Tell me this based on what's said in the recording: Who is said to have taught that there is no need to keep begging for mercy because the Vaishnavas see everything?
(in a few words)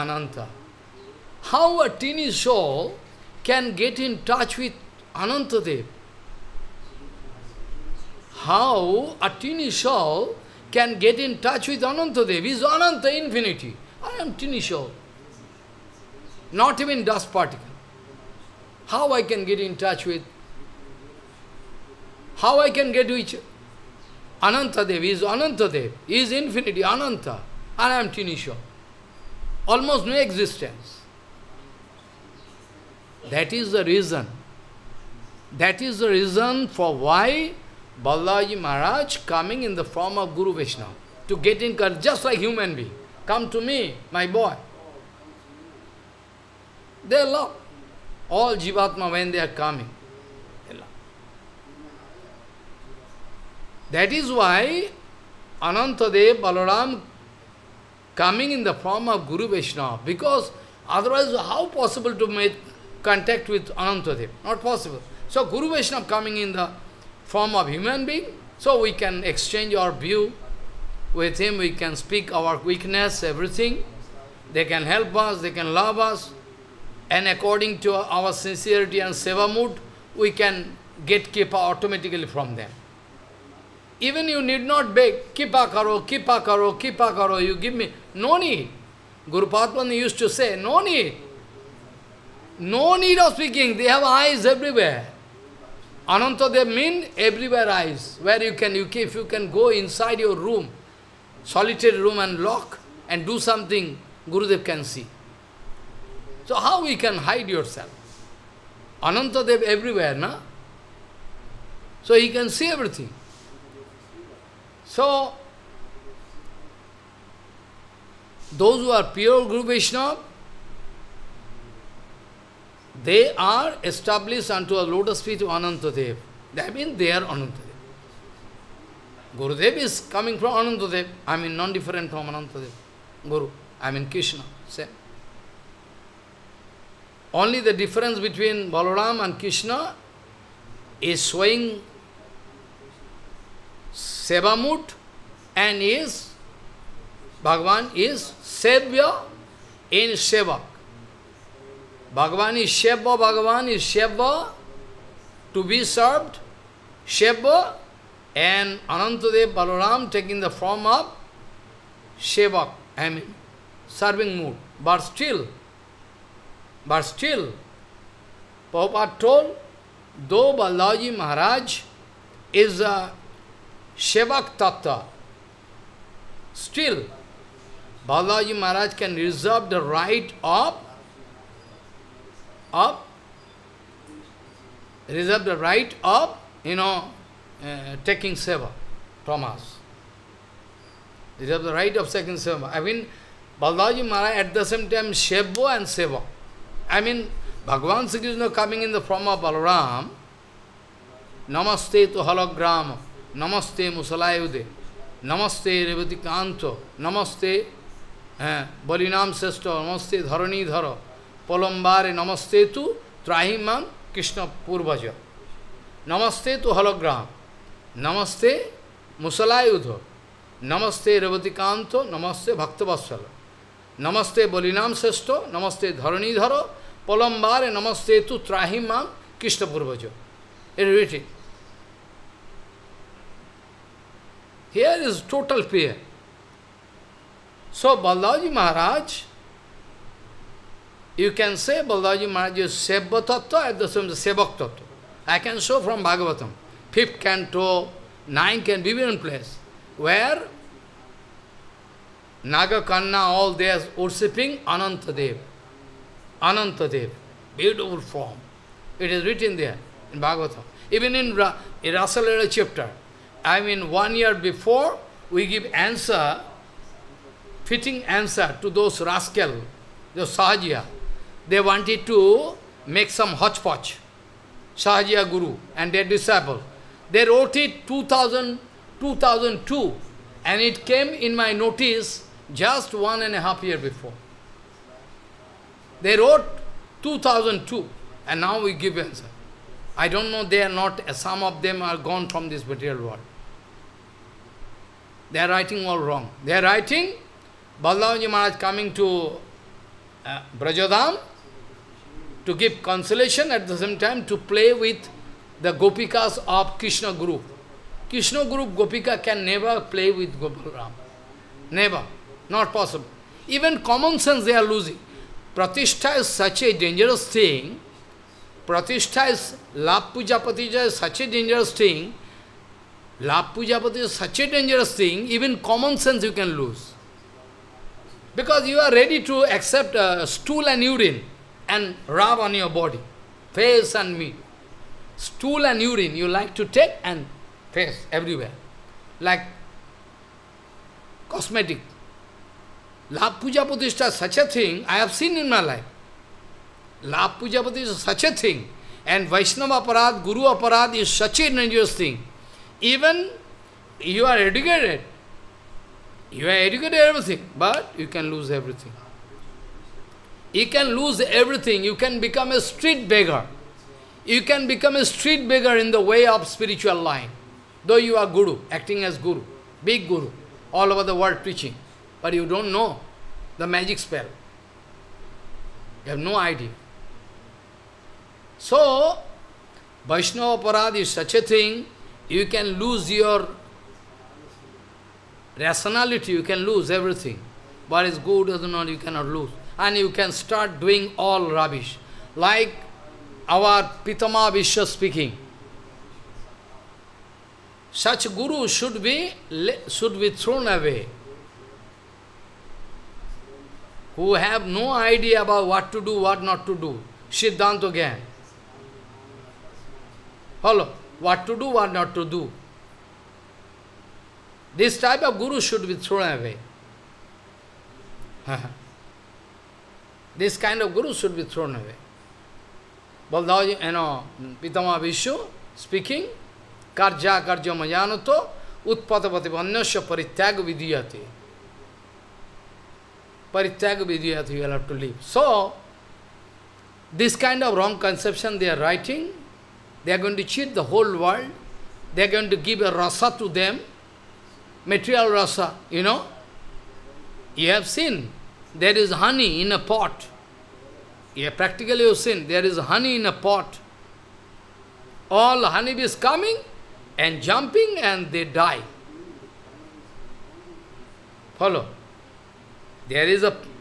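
Guru Patman.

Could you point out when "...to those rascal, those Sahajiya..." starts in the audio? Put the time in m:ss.
4:28.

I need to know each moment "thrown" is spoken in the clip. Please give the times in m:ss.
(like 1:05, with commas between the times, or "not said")
6:40, 6:55, 7:01.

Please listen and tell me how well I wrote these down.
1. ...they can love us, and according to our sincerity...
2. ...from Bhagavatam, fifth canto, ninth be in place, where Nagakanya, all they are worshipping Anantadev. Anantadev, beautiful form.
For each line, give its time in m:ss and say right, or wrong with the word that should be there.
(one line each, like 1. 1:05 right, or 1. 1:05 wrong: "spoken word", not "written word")
1. 1:15 right
2. 4:05 right.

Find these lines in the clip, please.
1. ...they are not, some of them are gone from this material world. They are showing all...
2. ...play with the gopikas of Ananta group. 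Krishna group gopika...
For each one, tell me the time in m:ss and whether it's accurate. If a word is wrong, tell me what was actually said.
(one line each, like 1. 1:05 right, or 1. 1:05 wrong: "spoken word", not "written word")
1. 4:50 wrong: "writing", not "showing"
2. 5:04 wrong: "Krishna", not "Ananta".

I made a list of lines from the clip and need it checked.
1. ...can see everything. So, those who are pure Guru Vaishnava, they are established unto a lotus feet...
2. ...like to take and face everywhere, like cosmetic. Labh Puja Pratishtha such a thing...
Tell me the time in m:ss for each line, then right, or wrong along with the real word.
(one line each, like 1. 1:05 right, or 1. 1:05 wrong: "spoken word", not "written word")
1. 1:52 right
2. 5:36 right.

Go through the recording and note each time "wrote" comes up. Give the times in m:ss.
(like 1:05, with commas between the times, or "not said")
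4:37, 4:46.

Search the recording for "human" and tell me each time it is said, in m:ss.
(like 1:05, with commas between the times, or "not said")
0:42, 1:07.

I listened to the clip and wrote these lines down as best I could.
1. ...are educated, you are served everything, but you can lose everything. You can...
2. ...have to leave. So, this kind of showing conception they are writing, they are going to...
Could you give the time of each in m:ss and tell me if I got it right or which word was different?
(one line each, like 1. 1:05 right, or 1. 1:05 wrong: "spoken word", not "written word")
1. 5:54 wrong: "educated", not "served"
2. 7:14 wrong: "wrong", not "showing".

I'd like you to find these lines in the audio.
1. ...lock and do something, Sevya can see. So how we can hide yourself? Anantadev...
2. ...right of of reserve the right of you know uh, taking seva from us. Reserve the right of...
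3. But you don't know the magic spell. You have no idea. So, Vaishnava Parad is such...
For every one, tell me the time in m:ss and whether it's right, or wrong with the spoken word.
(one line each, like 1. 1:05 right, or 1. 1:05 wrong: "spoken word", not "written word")
1. 1:42 wrong: "Gurudev", not "Sevya"
2. 2:59 right
3. 6:12 right.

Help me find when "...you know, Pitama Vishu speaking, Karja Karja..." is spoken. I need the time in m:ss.
7:03.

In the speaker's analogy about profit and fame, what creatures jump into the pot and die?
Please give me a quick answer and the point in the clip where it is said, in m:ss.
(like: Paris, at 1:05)
Honeybees, at 7:35.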